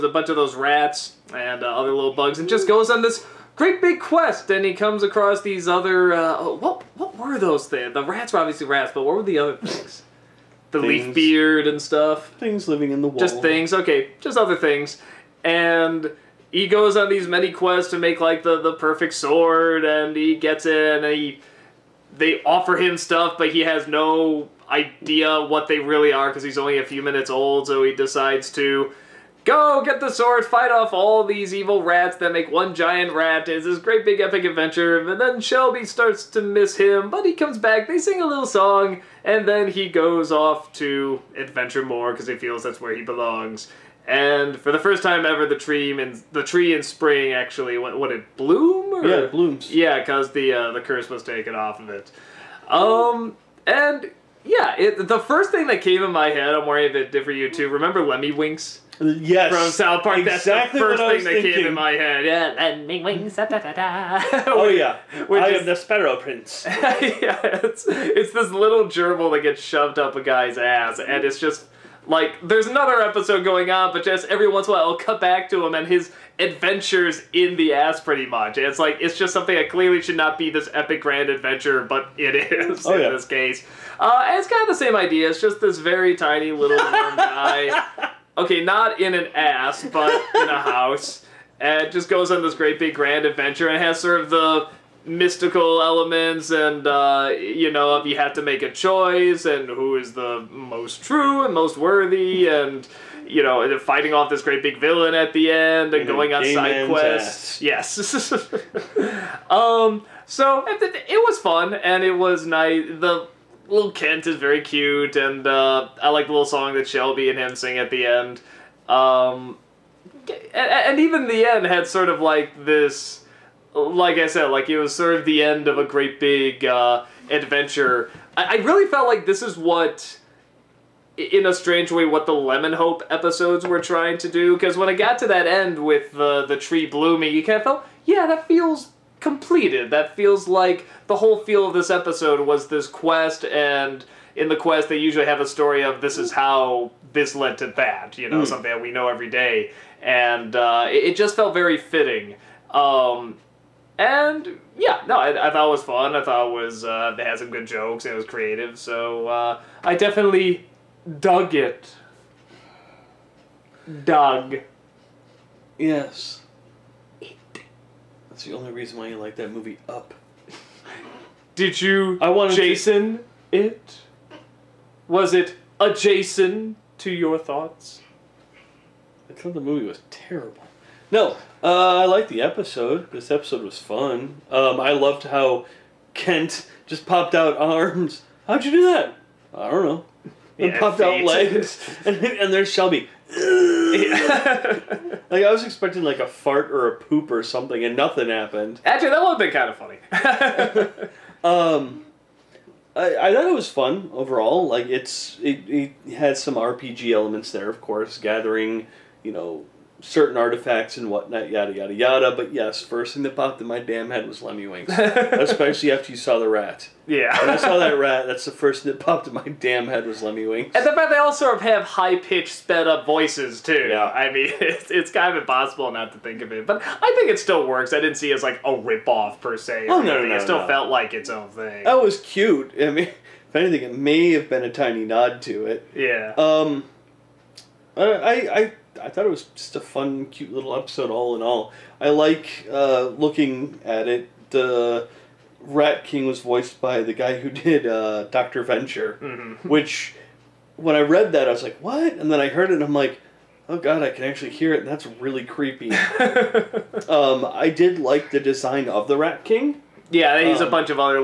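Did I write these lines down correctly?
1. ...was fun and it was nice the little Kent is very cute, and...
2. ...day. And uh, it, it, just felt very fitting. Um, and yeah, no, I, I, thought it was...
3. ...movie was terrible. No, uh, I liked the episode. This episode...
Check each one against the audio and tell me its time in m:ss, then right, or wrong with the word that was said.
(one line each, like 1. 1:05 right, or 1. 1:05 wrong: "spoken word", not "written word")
1. 1:51 right
2. 2:29 right
3. 2:59 right.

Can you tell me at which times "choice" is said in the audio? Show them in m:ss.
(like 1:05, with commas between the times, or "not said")
1:38.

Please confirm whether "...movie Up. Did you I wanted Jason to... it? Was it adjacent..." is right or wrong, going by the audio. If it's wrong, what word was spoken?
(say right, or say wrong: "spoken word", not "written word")
right.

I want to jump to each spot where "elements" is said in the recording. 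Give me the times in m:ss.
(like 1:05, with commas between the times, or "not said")
1:35, 3:27.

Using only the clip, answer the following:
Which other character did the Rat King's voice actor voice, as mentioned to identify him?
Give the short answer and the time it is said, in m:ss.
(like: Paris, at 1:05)
Doctor Venture, at 4:08.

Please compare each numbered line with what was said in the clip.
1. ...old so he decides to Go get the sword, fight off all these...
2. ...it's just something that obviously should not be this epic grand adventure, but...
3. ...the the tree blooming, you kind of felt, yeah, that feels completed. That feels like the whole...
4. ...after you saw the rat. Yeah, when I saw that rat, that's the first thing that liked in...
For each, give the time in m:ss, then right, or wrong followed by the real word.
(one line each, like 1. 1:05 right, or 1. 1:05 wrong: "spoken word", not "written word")
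1. 0:27 right
2. 1:18 wrong: "clearly", not "obviously"
3. 2:16 right
4. 3:35 wrong: "popped", not "liked".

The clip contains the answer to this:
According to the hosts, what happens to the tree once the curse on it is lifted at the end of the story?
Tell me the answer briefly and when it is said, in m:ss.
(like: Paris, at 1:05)
It blooms, at 0:49.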